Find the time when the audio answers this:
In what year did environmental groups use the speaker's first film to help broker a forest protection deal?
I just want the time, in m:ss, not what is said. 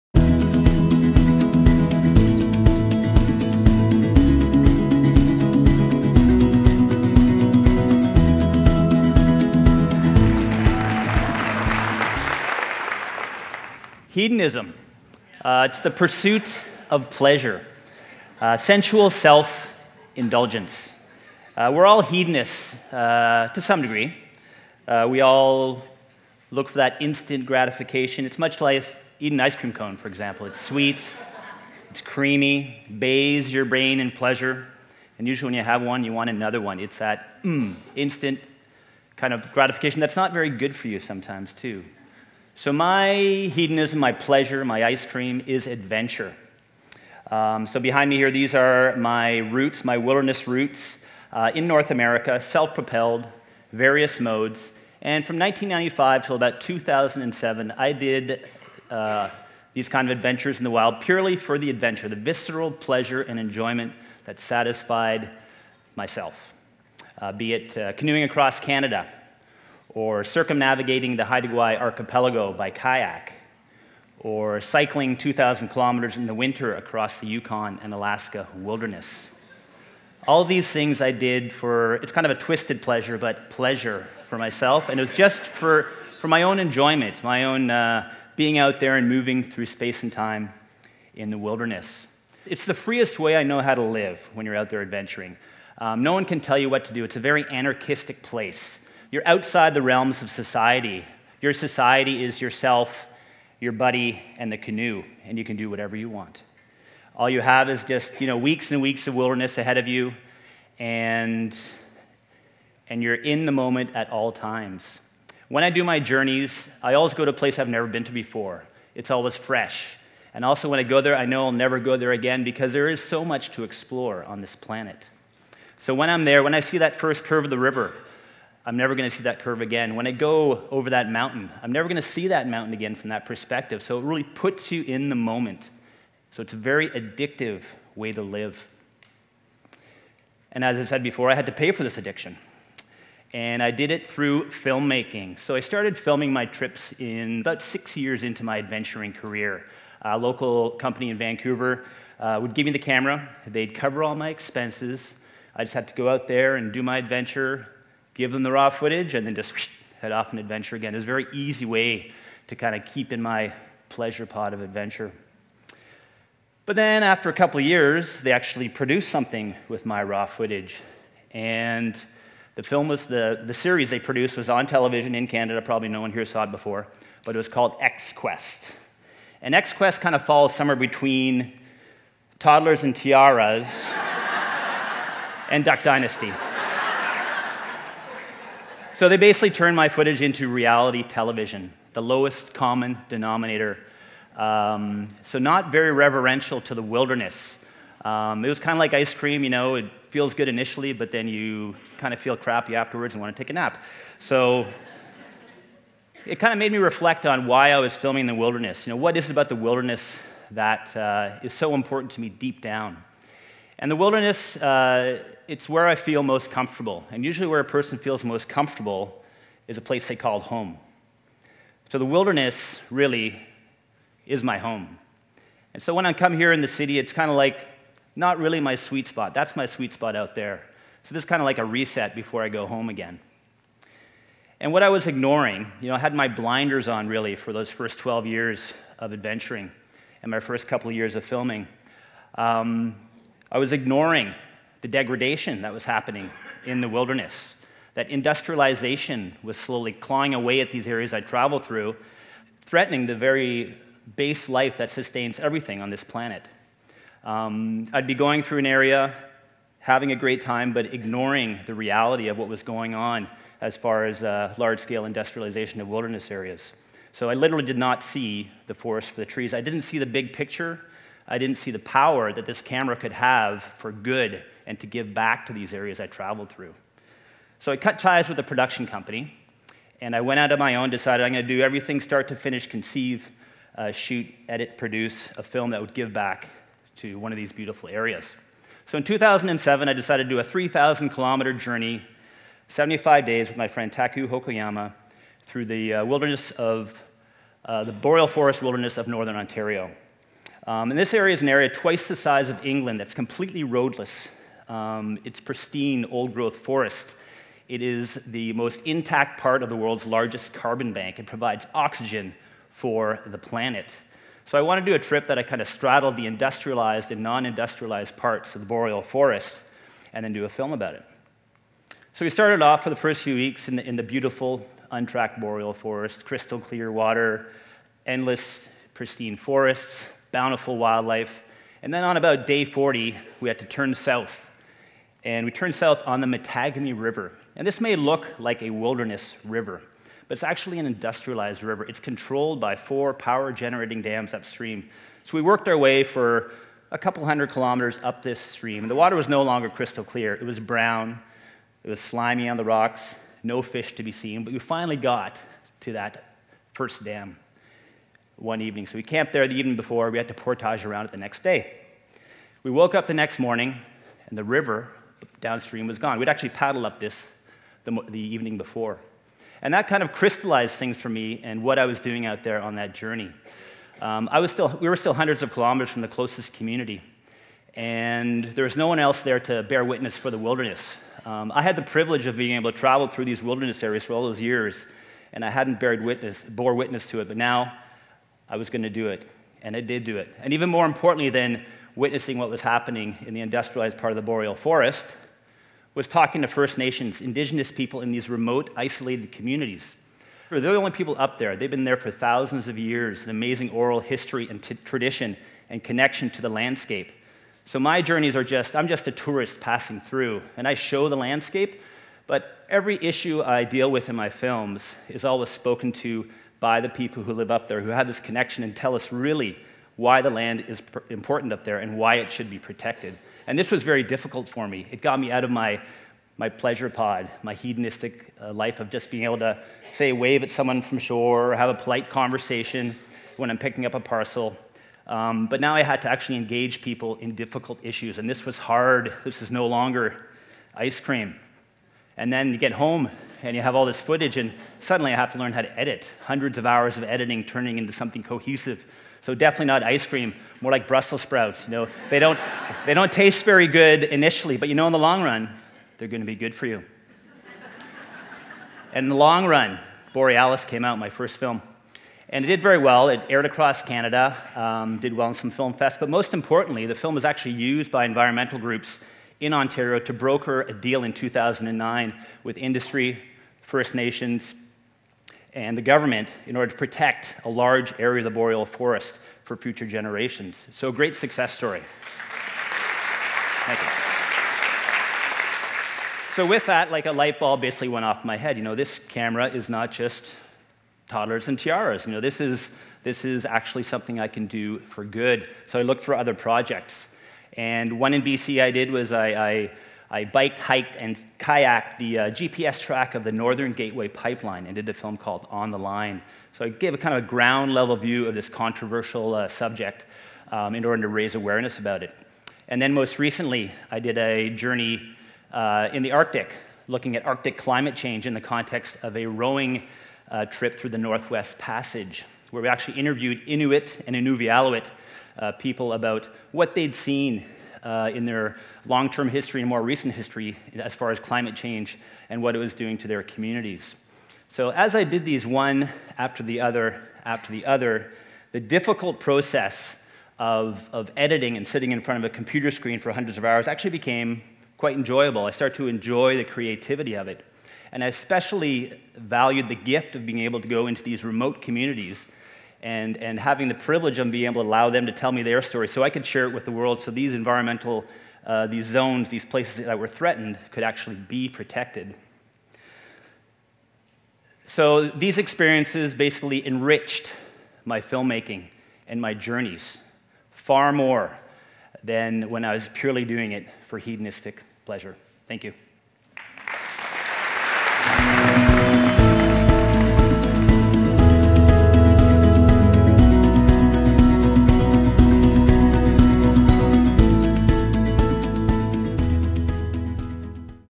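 7:51.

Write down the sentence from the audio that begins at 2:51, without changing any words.
And the film was the, the series they produced was on television in Canada.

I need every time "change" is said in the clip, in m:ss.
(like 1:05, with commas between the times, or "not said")
8:37, 8:51.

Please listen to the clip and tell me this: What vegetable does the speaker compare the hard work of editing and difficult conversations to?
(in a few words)
Brussels sprouts.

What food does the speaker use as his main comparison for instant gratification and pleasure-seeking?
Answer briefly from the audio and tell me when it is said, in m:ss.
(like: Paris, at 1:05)
ice cream cone, at 0:29.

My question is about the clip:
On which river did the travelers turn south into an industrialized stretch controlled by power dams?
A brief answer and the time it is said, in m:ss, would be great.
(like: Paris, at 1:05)
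Mattagami River, at 5:36.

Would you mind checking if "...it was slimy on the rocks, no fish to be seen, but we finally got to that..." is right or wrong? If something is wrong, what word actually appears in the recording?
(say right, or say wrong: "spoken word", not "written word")
right.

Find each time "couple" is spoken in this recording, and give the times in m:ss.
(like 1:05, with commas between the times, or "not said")
2:47, 4:00, 5:46.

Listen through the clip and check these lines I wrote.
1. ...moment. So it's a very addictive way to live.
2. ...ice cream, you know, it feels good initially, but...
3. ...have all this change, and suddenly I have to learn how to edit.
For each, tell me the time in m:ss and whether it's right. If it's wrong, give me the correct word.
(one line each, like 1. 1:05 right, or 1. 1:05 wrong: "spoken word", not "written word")
1. 2:15 right
2. 3:18 right
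3. 7:23 wrong: "footage", not "change".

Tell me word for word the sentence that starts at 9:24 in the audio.
So these experiences basically enriched my filmmaking and my journeys far more than when I was purely doing it for hedonistic pleasure.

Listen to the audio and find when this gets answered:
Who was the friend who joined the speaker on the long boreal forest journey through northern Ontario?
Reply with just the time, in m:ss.
4:53.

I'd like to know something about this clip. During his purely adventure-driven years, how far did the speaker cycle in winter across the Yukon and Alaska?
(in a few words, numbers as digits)
2,000 kilometers.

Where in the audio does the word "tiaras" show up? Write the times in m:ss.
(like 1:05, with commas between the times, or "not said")
3:02, 8:11.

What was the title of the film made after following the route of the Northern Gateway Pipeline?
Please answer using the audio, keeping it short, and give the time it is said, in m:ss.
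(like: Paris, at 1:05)
On the Line, at 8:25.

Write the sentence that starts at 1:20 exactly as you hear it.
All these things I did for, it's kind of a twisted pleasure, but pleasure for myself.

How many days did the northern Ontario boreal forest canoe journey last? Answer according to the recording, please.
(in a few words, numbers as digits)
75 days.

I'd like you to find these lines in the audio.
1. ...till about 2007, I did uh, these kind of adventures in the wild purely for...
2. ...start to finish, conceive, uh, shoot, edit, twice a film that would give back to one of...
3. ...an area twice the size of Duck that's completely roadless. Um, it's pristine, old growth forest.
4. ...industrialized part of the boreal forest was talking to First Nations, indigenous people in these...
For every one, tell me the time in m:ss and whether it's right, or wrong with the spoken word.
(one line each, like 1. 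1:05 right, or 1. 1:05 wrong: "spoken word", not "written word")
1. 0:56 right
2. 4:42 wrong: "produce", not "twice"
3. 5:01 wrong: "England", not "Duck"
4. 6:33 right.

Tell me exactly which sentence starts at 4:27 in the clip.
So I literally did not see the forest for the trees.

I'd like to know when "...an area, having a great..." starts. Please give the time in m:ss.
4:18.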